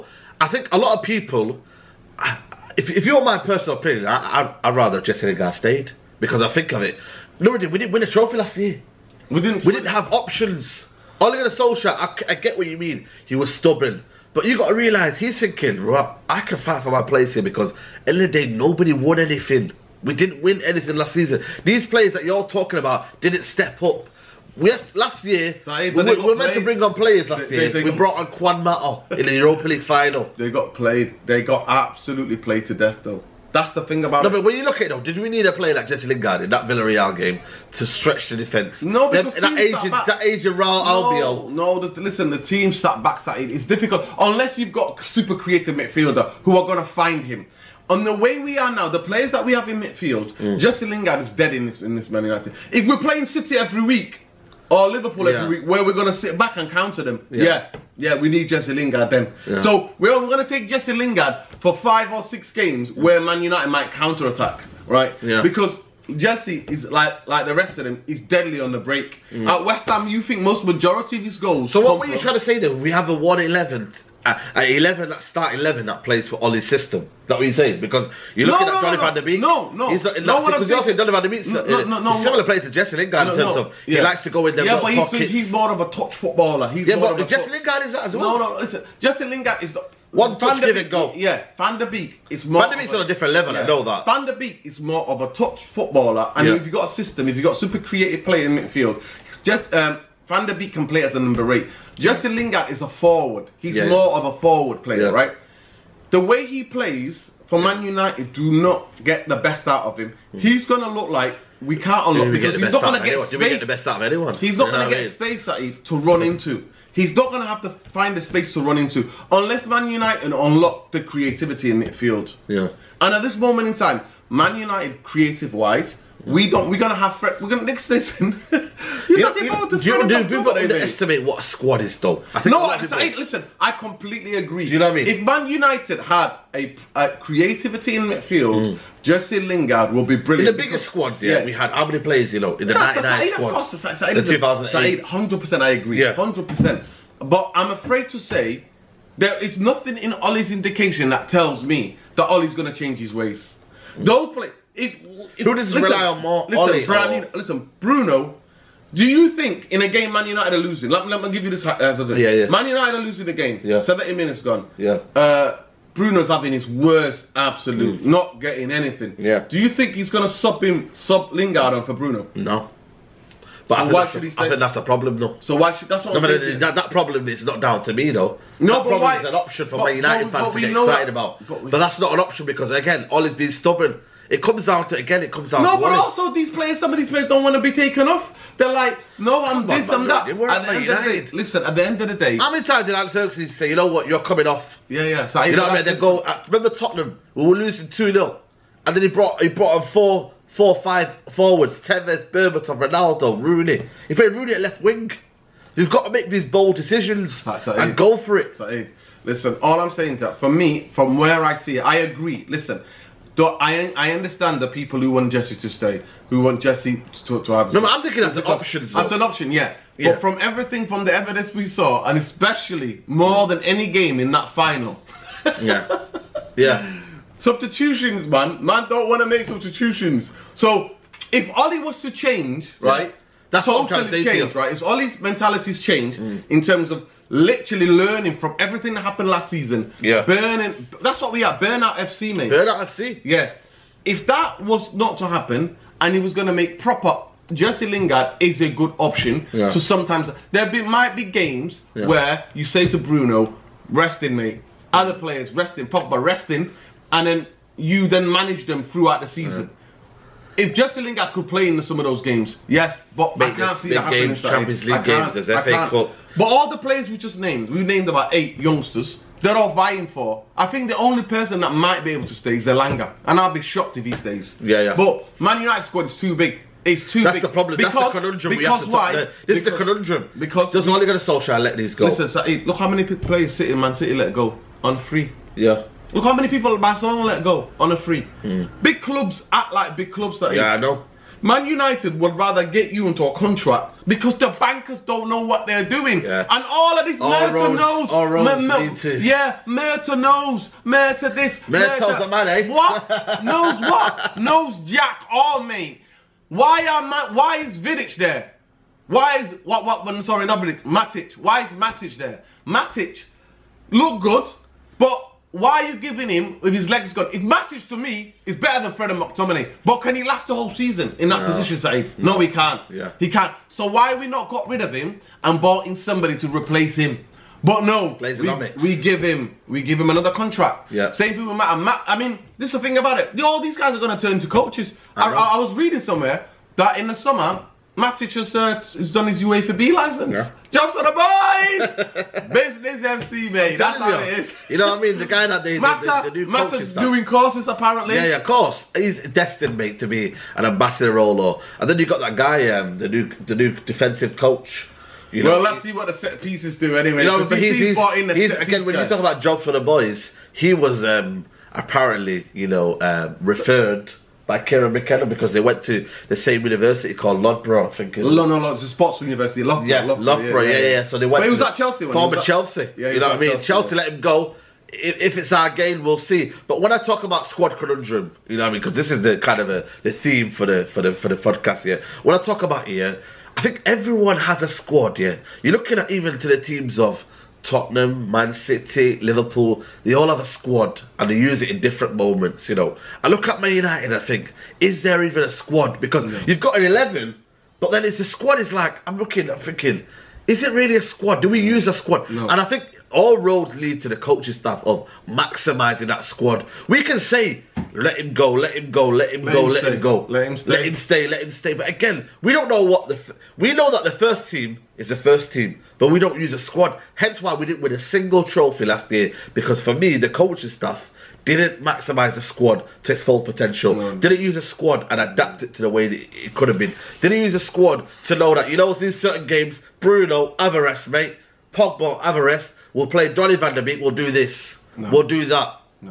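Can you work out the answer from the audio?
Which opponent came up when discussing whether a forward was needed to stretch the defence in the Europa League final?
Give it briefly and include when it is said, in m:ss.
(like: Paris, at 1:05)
Villarreal, at 0:36.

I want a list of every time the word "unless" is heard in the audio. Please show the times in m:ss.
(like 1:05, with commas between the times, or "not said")
0:44, 1:59.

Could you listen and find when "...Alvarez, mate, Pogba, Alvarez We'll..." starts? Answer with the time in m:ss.
7:10.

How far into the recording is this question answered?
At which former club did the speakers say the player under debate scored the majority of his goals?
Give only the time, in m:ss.
1:09.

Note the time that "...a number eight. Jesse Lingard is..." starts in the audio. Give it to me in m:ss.
1:41.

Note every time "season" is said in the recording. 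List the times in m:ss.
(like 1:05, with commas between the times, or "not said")
0:21, 3:59, 4:19, 5:20.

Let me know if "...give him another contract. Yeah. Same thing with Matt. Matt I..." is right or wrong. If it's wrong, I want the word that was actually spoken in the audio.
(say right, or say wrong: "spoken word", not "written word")
right.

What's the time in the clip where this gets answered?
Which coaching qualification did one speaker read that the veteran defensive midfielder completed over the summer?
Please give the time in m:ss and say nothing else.
5:39.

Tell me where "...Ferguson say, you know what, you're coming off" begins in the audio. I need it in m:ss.
3:13.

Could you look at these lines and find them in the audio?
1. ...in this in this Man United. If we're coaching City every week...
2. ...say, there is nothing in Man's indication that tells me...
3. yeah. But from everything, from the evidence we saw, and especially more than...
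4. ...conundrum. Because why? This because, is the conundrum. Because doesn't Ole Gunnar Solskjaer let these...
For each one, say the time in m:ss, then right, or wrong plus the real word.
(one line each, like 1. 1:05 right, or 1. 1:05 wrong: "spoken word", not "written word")
1. 0:51 wrong: "playing", not "coaching"
2. 2:28 wrong: "Ollie", not "Man"
3. 3:39 right
4. 4:38 right.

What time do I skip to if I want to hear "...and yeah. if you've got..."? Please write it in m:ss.
1:36.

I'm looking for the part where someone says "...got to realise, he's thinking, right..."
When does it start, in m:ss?
0:14.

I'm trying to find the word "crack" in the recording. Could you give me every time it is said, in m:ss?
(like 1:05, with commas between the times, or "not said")
not said.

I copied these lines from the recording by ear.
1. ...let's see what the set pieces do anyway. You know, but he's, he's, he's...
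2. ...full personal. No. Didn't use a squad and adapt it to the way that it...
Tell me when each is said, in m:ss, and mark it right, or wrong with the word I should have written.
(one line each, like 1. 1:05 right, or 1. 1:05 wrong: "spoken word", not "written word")
1. 5:55 right
2. 7:03 wrong: "potential", not "personal".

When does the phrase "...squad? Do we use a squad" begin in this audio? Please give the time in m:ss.
6:41.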